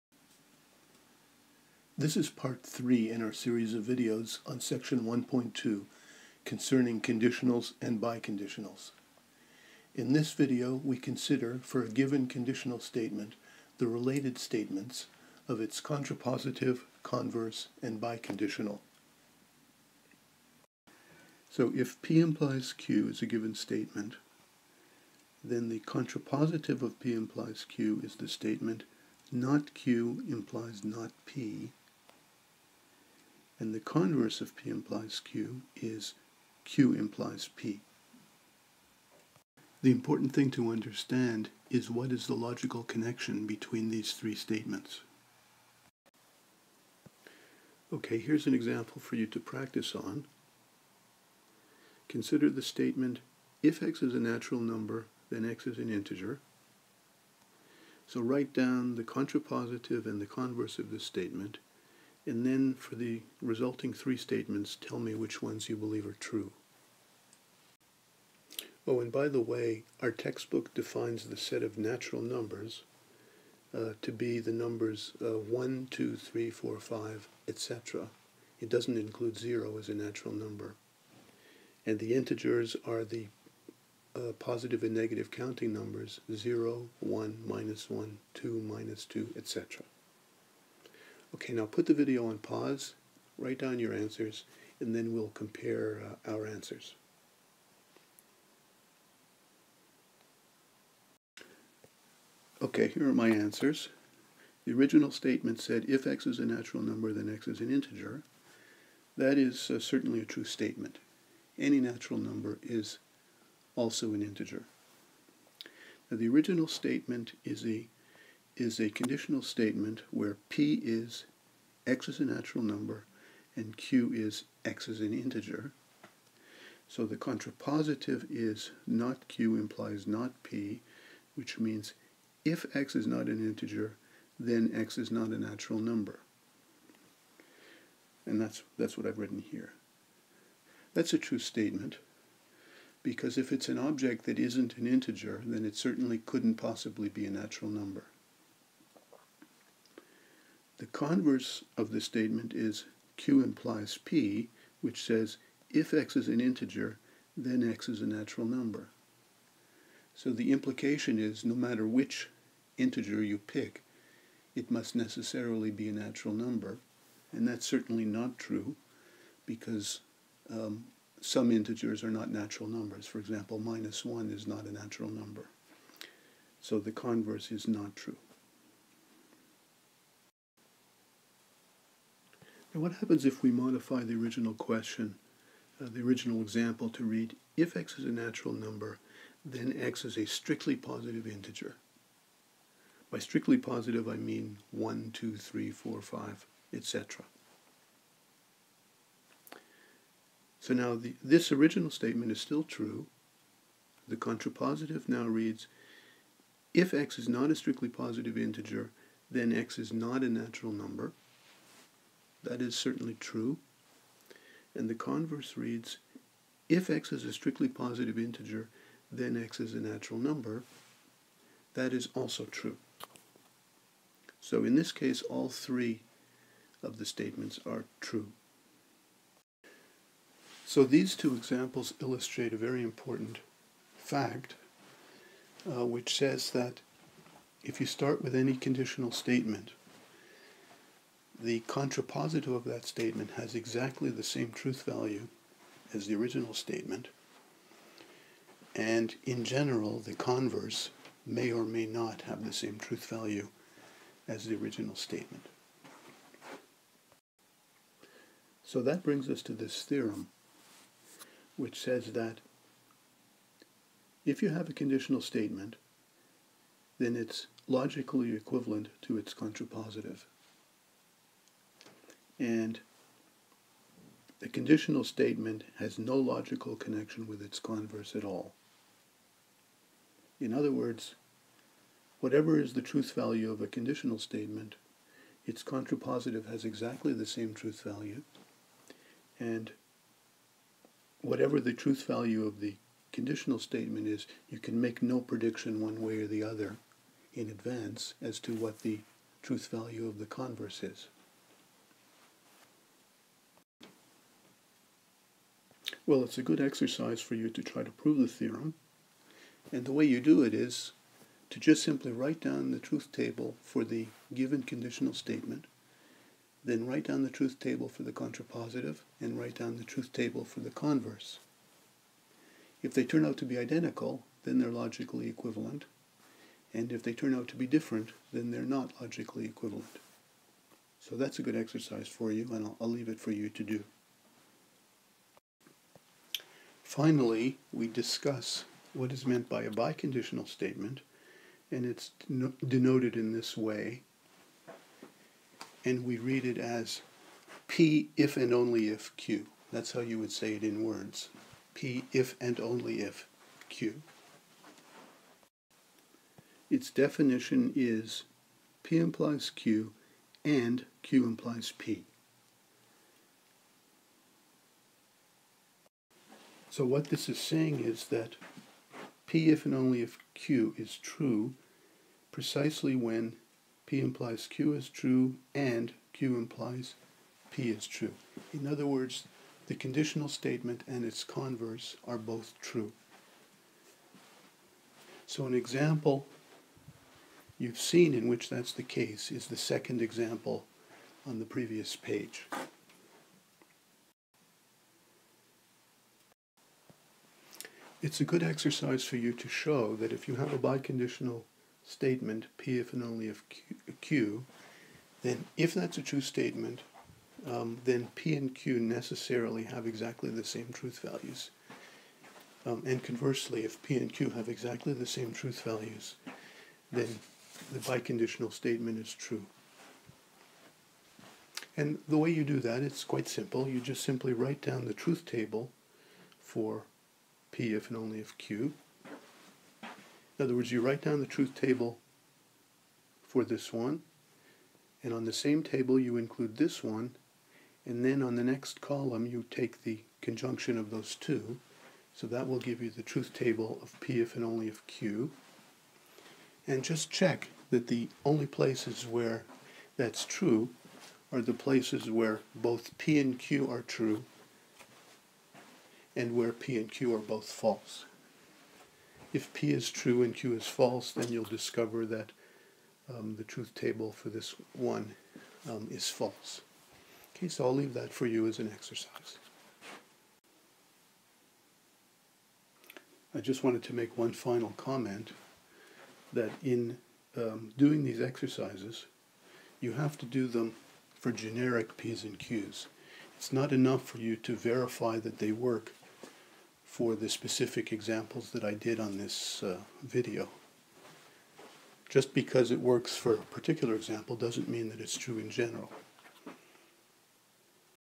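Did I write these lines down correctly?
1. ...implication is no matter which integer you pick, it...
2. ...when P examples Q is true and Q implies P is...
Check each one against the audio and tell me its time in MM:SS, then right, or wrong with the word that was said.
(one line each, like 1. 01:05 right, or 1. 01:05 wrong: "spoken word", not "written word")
1. 02:40 right
2. 06:12 wrong: "implies", not "examples".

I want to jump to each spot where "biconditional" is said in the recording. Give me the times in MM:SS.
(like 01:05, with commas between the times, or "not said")
00:08, 00:18, 05:39, 06:40, 06:57.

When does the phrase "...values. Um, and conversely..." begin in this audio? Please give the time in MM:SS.
06:51.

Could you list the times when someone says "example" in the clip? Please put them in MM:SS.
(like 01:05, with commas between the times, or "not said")
00:48, 02:53, 03:06, 03:51, 06:25, 06:30, 08:07, 08:13.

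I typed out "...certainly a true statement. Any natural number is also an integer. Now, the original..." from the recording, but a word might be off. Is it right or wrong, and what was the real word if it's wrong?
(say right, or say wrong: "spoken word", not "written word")
right.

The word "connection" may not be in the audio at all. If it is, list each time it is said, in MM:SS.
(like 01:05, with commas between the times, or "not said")
00:42, 04:36.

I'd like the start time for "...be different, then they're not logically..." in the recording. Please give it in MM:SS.
05:27.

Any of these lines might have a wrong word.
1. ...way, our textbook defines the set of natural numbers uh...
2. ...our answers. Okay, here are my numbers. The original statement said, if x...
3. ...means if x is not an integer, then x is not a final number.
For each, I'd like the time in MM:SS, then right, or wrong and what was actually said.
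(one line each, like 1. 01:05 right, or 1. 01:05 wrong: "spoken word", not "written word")
1. 01:09 right
2. 01:36 wrong: "answers", not "numbers"
3. 02:11 wrong: "natural", not "final".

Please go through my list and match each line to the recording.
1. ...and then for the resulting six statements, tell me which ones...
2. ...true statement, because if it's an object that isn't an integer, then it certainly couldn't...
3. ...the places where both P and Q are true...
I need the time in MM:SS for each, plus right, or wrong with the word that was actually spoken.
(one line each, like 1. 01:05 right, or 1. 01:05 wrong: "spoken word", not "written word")
1. 01:02 wrong: "three", not "six"
2. 02:21 right
3. 07:31 right.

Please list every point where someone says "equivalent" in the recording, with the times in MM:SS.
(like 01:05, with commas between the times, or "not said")
04:28, 05:25, 05:29.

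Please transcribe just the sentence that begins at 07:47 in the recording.
Okay, so I'll leave that for you as an exercise.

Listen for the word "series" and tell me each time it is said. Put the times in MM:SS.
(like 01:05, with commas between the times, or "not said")
00:03.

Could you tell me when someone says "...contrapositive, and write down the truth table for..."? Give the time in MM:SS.
05:18.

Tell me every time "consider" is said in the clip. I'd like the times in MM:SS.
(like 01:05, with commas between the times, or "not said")
00:10, 00:52.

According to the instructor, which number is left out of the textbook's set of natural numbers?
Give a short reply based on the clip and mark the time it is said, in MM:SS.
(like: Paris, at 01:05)
0, at 01:18.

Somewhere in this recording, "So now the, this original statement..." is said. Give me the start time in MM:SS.
03:20.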